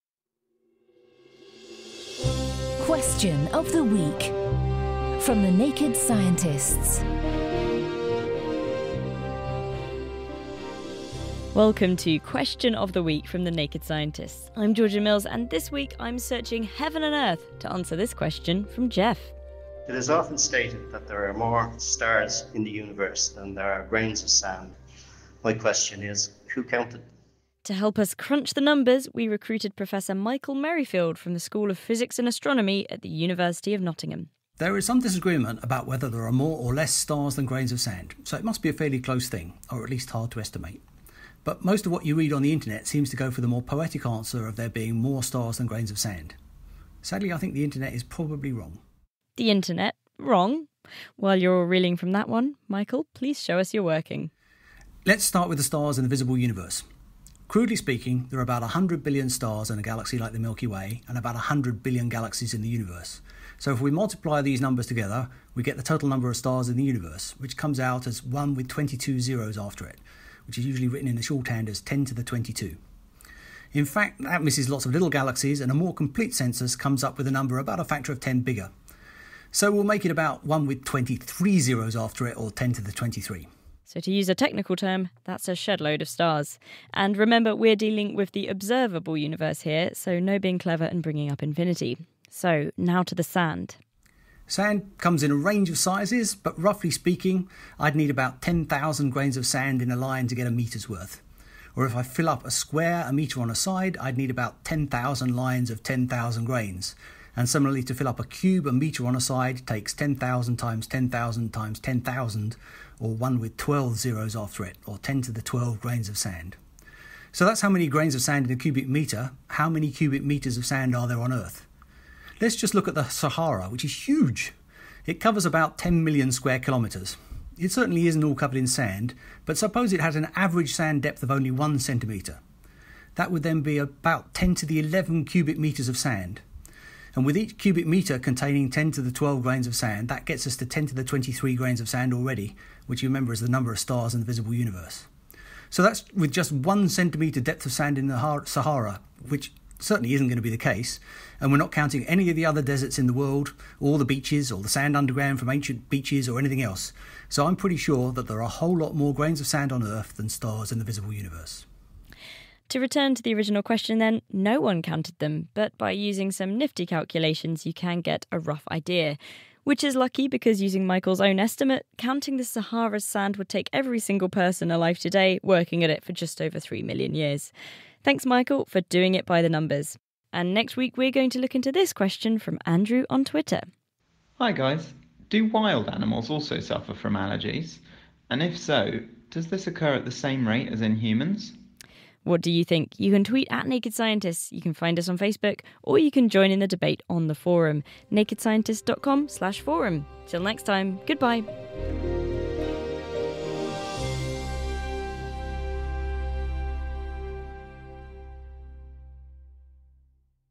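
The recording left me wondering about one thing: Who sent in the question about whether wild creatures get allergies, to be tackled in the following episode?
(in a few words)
Andrew.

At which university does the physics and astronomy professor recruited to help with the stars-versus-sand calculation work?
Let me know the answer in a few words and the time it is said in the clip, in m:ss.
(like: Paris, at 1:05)
University of Nottingham, at 0:33.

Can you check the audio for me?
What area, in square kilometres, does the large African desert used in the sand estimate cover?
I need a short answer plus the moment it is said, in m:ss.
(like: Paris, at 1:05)
10 million square kilometres, at 2:05.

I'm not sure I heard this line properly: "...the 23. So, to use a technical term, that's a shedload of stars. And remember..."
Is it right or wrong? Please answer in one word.
right.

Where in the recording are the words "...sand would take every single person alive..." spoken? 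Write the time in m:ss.
2:53.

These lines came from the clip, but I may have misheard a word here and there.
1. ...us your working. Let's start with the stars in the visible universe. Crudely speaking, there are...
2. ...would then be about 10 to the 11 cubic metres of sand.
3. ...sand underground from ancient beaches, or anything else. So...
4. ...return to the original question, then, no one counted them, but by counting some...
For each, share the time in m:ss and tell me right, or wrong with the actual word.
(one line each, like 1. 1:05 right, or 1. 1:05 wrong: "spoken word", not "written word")
1. 0:53 right
2. 2:13 right
3. 2:34 right
4. 2:42 wrong: "using", not "counting".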